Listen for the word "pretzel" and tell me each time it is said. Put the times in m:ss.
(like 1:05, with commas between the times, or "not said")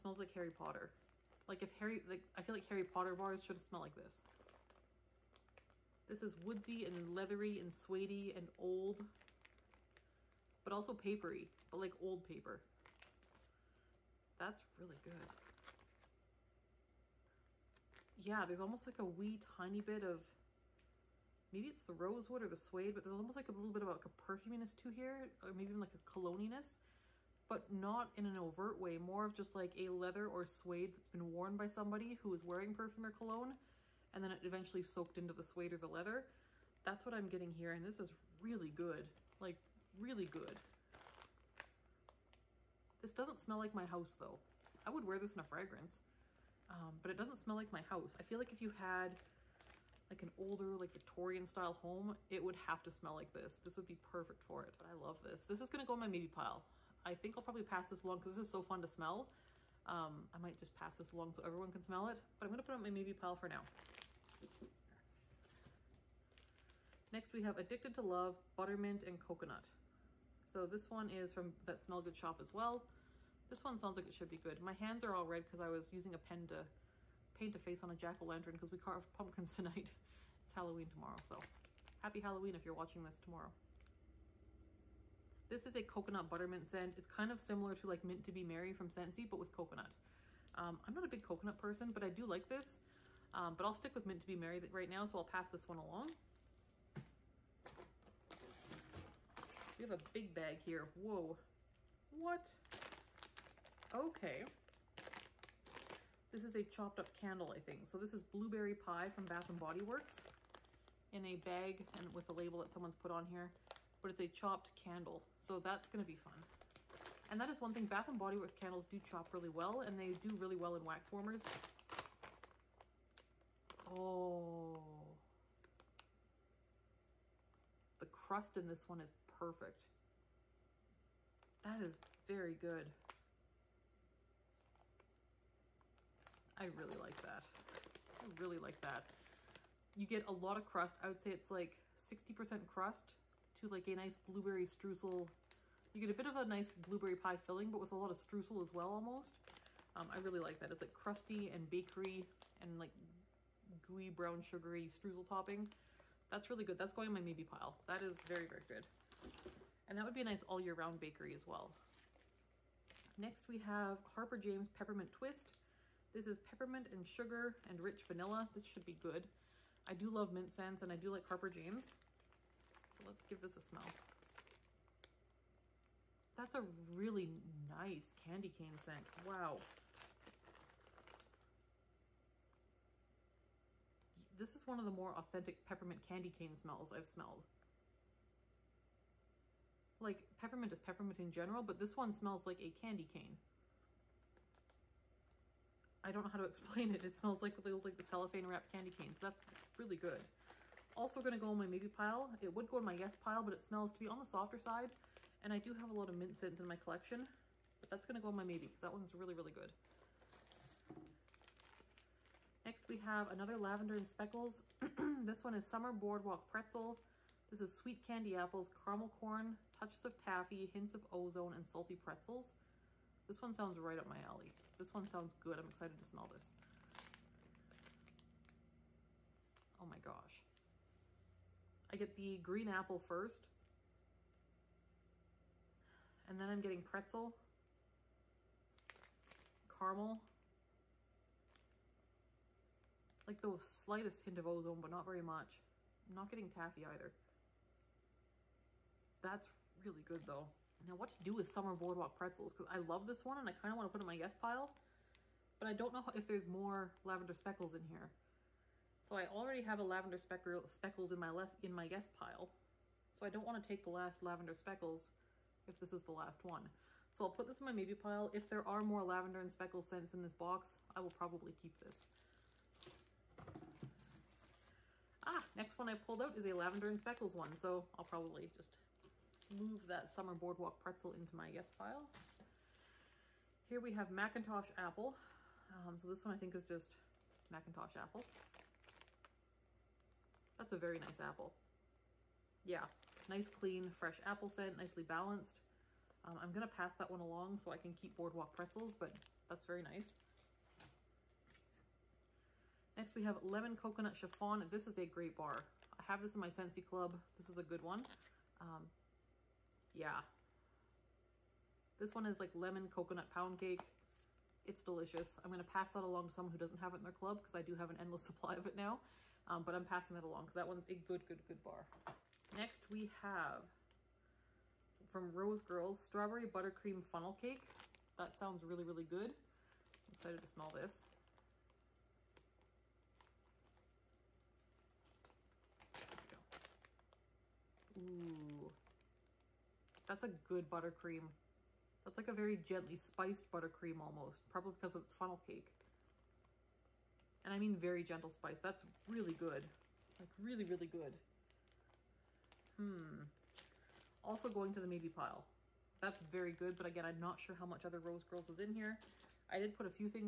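3:36, 3:41, 3:56, 4:12, 4:40, 4:58.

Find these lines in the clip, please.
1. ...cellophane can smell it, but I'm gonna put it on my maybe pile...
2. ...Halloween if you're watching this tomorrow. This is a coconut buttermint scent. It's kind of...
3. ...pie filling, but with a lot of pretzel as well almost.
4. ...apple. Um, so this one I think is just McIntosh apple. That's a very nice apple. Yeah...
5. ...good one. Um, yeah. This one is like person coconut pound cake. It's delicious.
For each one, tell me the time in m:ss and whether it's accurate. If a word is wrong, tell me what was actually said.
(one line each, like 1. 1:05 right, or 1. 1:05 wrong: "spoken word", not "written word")
1. 1:01 wrong: "everyone", not "cellophane"
2. 1:22 right
3. 2:27 wrong: "streusel", not "pretzel"
4. 4:44 right
5. 5:07 wrong: "lemon", not "person".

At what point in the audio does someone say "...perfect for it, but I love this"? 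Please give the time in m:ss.
0:53.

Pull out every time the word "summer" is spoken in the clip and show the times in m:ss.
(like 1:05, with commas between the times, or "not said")
3:35, 4:11, 4:40.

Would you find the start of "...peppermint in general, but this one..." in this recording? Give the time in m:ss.
3:10.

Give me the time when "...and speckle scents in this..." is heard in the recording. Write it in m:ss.
4:29.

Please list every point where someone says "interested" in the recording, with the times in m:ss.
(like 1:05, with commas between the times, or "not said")
not said.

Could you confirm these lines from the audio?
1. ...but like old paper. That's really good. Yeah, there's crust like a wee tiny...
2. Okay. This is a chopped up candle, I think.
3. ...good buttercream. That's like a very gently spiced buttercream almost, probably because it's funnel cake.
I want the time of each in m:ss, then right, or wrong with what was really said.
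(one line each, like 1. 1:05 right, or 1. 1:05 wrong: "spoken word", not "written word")
1. 0:11 wrong: "almost", not "crust"
2. 1:43 right
3. 5:40 right.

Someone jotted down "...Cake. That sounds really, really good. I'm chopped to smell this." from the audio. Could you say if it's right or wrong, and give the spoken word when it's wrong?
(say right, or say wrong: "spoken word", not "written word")
wrong: "excited", not "chopped".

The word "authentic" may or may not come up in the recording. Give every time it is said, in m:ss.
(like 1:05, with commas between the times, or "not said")
3:05.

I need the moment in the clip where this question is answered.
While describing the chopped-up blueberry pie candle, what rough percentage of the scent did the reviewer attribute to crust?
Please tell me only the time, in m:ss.
2:21.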